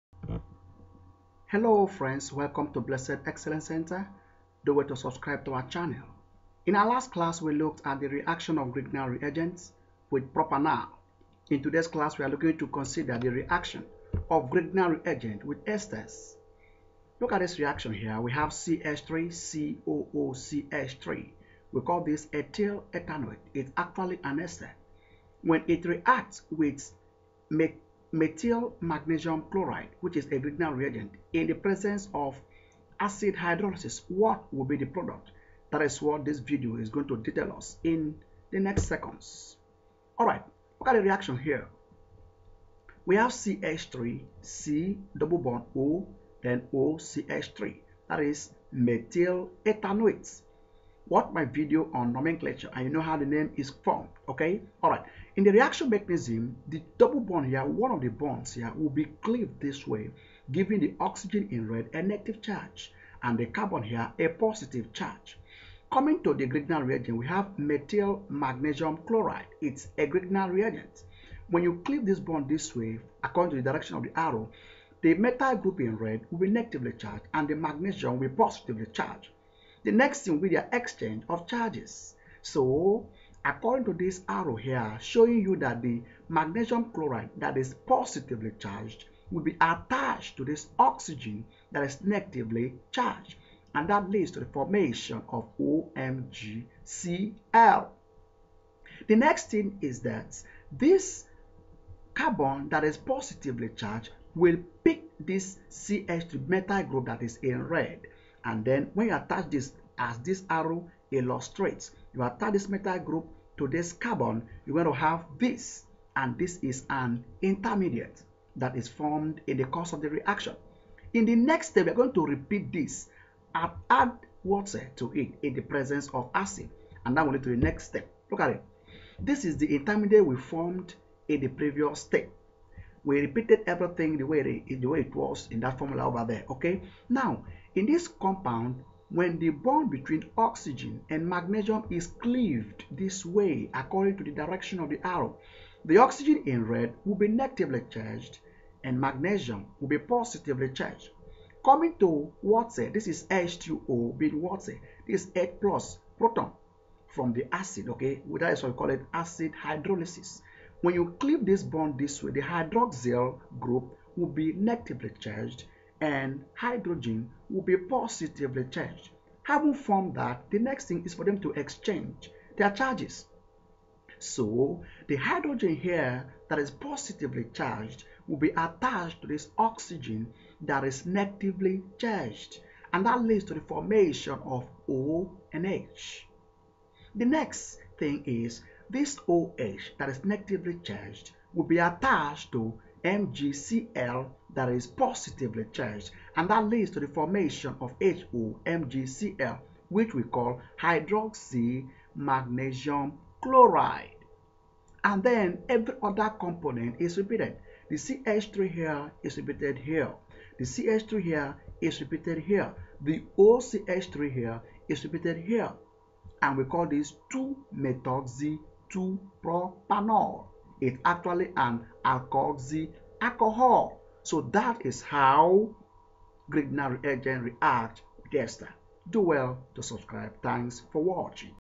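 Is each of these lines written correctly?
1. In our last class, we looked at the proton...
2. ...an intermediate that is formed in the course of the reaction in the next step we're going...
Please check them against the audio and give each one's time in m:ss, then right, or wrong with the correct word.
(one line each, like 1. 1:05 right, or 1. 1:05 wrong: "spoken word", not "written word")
1. 0:06 wrong: "reaction", not "proton"
2. 1:56 right.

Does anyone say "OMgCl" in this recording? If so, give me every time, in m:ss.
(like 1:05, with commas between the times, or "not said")
1:35.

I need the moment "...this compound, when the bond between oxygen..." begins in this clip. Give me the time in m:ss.
2:17.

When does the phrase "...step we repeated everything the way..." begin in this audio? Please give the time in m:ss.
2:12.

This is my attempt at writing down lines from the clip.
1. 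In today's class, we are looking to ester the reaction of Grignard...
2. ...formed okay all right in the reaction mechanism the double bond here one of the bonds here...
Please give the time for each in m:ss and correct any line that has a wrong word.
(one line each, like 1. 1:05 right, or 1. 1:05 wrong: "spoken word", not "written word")
1. 0:11 wrong: "consider", not "ester"
2. 0:53 right.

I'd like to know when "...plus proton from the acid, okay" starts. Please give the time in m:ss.
2:35.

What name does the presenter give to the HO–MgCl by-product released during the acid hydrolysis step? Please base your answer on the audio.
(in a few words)
hydroxy magnesium chloride.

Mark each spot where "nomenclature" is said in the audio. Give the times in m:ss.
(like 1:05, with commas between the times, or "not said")
0:52.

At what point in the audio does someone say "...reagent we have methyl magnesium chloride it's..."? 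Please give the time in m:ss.
1:06.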